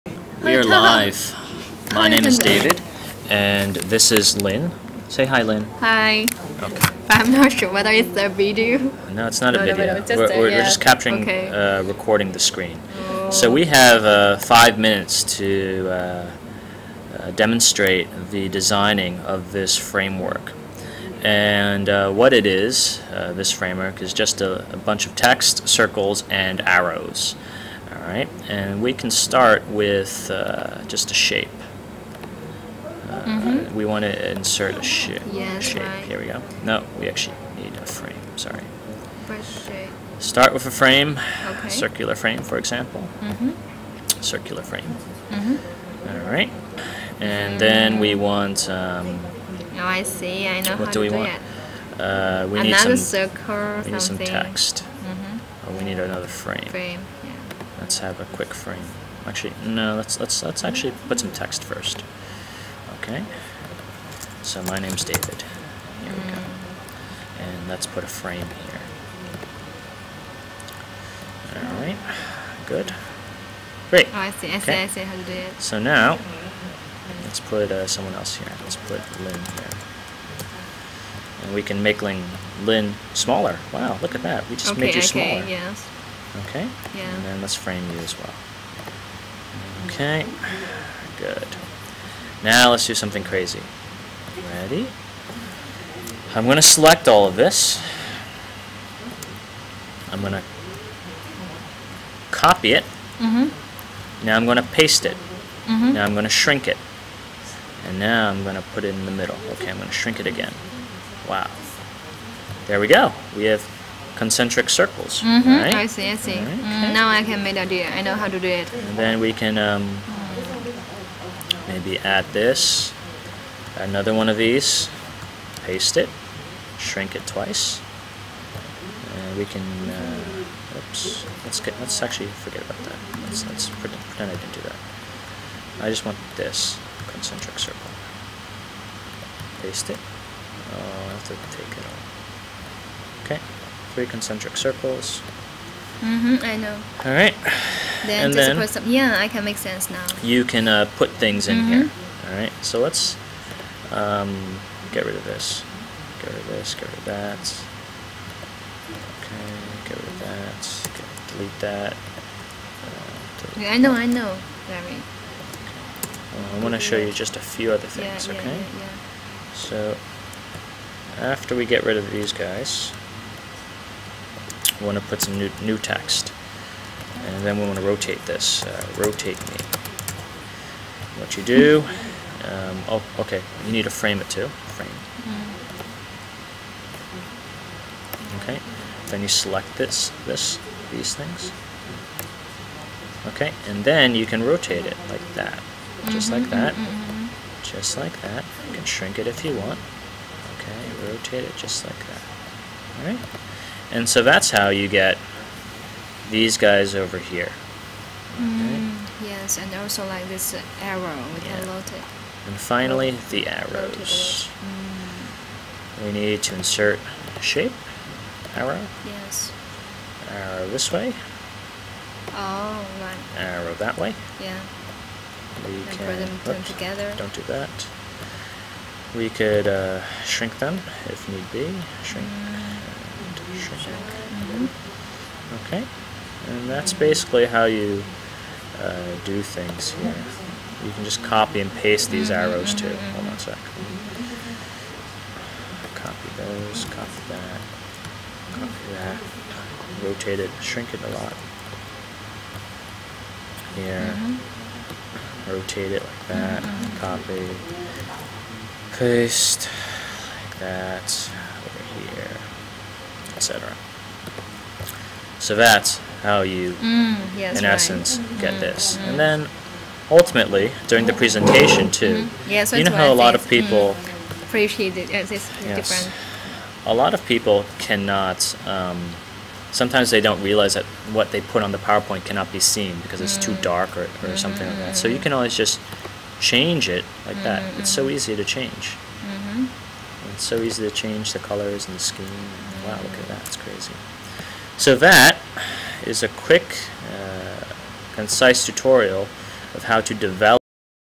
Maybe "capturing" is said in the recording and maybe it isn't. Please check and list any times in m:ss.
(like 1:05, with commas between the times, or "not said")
0:10.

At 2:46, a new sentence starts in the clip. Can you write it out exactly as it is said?
Well, I want to show you just a few other things.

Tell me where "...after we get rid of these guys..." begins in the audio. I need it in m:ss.
2:51.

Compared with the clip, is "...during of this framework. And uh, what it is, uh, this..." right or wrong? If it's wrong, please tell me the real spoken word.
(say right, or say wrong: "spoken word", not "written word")
wrong: "designing", not "during".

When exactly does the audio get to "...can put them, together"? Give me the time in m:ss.
3:45.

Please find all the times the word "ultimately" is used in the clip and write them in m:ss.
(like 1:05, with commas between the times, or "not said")
4:30.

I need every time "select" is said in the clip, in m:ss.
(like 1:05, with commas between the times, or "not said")
1:36, 3:09.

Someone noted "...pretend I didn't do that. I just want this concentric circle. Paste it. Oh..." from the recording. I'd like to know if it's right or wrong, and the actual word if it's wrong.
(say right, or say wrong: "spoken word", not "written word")
right.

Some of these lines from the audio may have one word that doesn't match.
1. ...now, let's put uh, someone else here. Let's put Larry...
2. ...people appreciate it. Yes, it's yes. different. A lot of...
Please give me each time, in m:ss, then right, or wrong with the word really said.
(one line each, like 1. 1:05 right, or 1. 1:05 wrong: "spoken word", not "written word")
1. 1:15 wrong: "Lynn", not "Larry"
2. 4:33 right.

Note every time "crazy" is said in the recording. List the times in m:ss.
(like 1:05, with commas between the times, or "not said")
1:33, 4:53.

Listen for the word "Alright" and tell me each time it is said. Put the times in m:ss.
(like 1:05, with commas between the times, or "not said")
0:28, 1:11, 3:23.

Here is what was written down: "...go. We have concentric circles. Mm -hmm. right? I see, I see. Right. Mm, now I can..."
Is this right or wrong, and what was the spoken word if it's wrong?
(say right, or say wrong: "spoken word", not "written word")
right.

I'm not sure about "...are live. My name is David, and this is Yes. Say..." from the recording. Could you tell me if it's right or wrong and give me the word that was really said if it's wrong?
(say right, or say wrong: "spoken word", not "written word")
wrong: "Lynn", not "Yes".